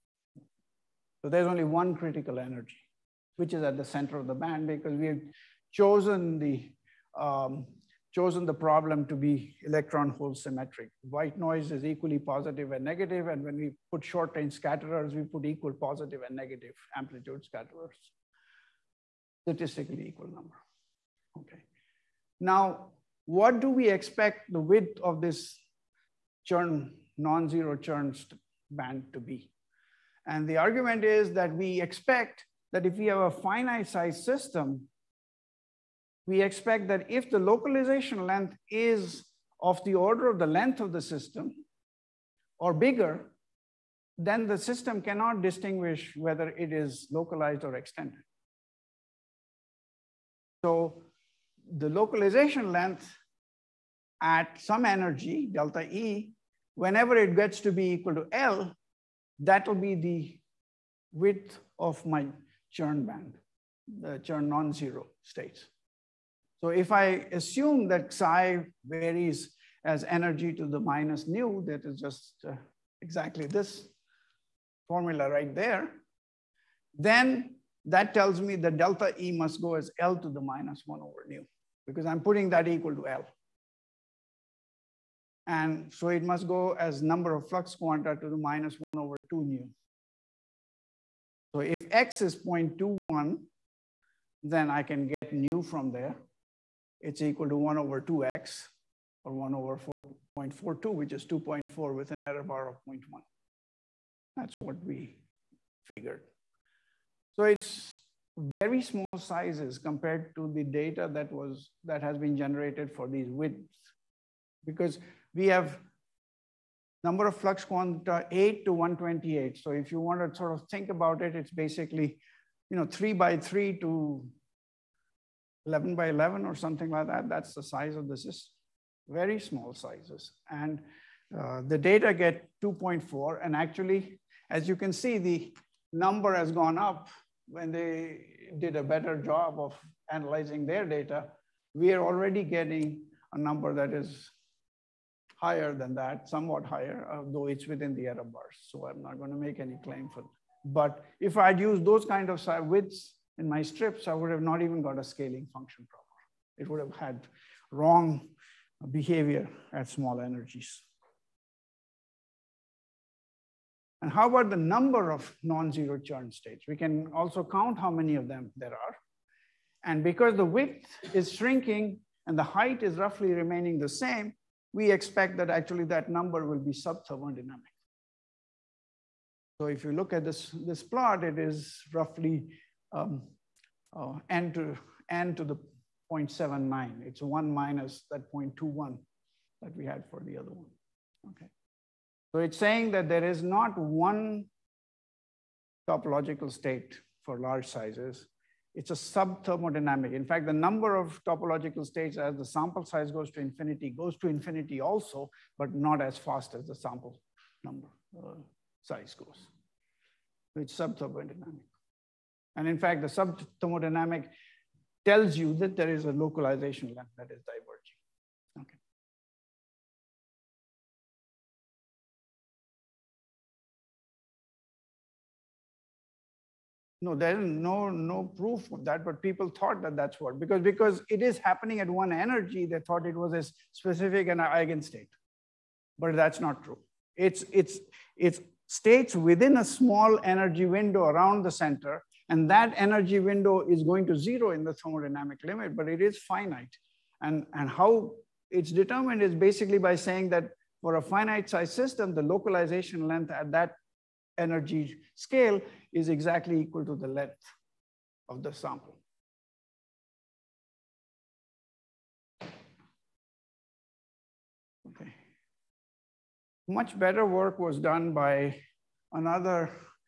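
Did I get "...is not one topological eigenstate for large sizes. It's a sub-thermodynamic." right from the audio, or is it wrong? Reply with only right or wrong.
wrong.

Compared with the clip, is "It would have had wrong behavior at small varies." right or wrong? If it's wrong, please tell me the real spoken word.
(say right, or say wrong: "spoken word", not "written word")
wrong: "energies", not "varies".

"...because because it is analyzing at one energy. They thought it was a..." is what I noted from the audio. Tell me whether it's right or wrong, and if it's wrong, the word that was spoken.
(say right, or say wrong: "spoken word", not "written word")
wrong: "happening", not "analyzing".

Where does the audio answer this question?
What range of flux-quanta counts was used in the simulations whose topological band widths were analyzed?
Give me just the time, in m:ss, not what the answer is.
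1:58.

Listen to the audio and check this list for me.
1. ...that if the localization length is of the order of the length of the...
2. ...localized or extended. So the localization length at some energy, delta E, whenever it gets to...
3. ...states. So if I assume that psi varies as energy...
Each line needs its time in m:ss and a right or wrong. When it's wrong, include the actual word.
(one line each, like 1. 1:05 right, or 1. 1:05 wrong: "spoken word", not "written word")
1. 0:36 right
2. 0:47 right
3. 1:05 right.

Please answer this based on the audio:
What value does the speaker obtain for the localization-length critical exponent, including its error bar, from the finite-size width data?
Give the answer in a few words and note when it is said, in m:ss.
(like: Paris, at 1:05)
2.4 with an error bar of 0.1, at 1:41.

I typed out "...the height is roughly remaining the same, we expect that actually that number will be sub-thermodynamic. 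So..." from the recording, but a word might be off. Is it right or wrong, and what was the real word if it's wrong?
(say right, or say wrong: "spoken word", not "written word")
right.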